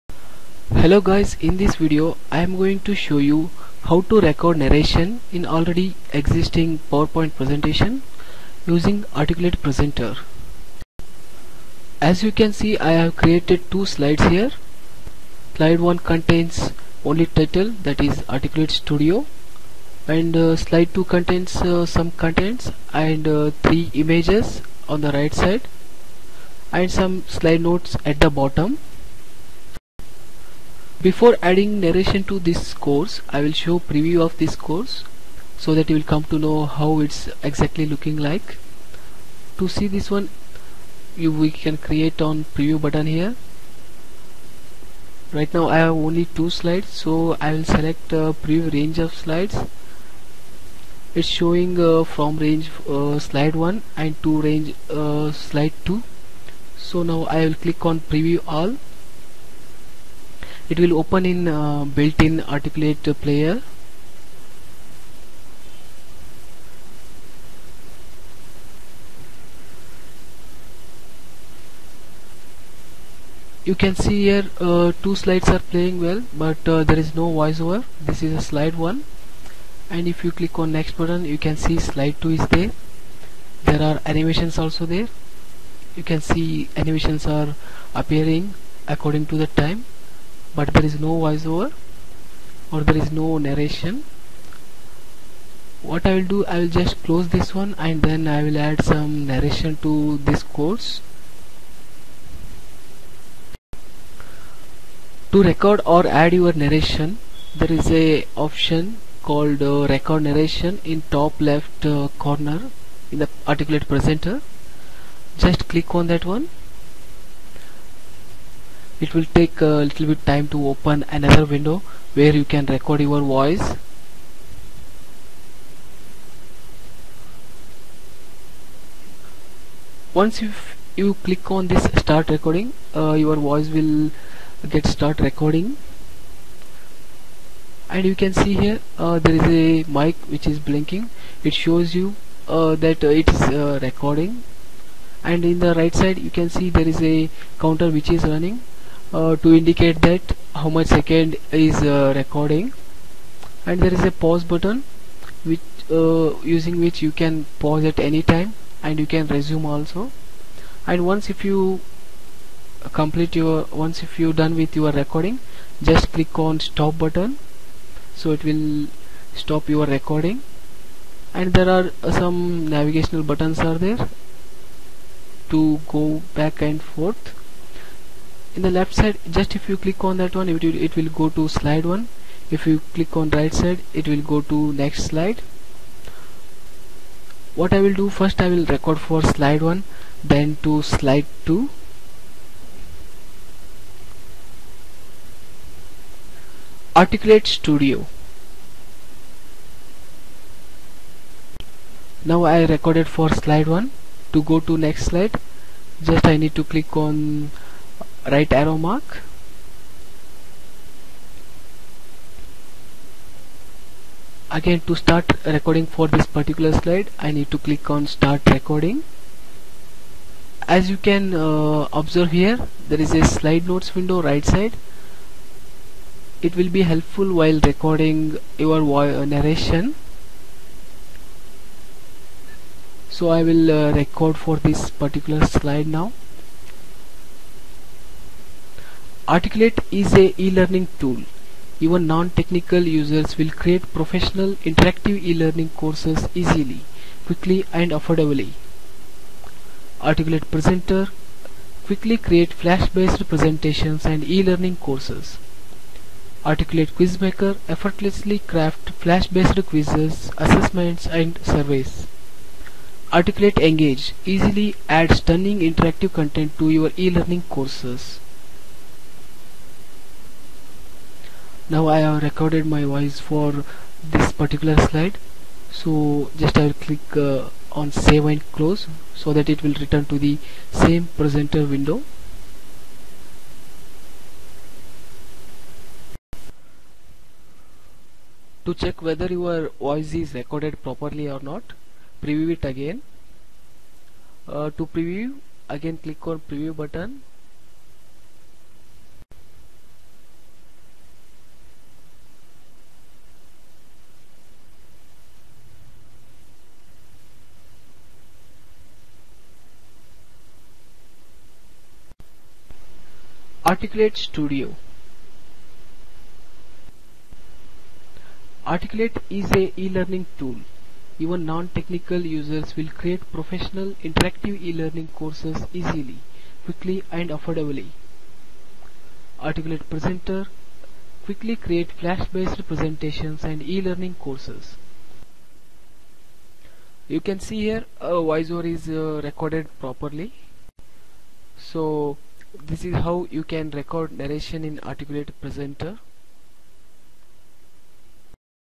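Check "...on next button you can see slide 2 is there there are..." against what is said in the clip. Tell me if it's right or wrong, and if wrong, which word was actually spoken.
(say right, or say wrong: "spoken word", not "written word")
right.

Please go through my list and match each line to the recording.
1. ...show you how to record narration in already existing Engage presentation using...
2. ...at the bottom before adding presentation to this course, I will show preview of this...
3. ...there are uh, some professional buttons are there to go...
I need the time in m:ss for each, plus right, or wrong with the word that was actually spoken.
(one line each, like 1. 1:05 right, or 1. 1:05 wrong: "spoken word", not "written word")
1. 0:02 wrong: "PowerPoint", not "Engage"
2. 0:28 wrong: "narration", not "presentation"
3. 2:51 wrong: "navigational", not "professional".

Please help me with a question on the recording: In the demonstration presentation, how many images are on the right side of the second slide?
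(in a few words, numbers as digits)
3.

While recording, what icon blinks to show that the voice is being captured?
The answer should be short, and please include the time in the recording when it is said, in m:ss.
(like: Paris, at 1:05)
a mic, at 2:19.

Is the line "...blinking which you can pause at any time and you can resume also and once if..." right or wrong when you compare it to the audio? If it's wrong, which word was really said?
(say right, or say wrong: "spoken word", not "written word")
wrong: "using", not "blinking".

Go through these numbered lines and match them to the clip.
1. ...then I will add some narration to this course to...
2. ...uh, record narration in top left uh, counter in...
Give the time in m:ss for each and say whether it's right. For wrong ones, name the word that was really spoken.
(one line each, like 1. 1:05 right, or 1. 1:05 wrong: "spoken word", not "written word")
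1. 1:38 right
2. 1:49 wrong: "corner", not "counter".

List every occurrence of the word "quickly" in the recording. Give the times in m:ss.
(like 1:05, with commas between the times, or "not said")
4:07, 4:11, 5:26, 5:31.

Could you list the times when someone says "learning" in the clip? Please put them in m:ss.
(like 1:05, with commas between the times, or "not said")
4:00, 4:05, 4:14, 4:26, 5:19, 5:24, 5:33.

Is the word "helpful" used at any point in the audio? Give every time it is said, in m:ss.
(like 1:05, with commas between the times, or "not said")
3:46.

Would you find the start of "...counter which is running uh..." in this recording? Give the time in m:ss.
2:27.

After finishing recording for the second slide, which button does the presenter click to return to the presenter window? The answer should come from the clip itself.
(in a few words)
save and close.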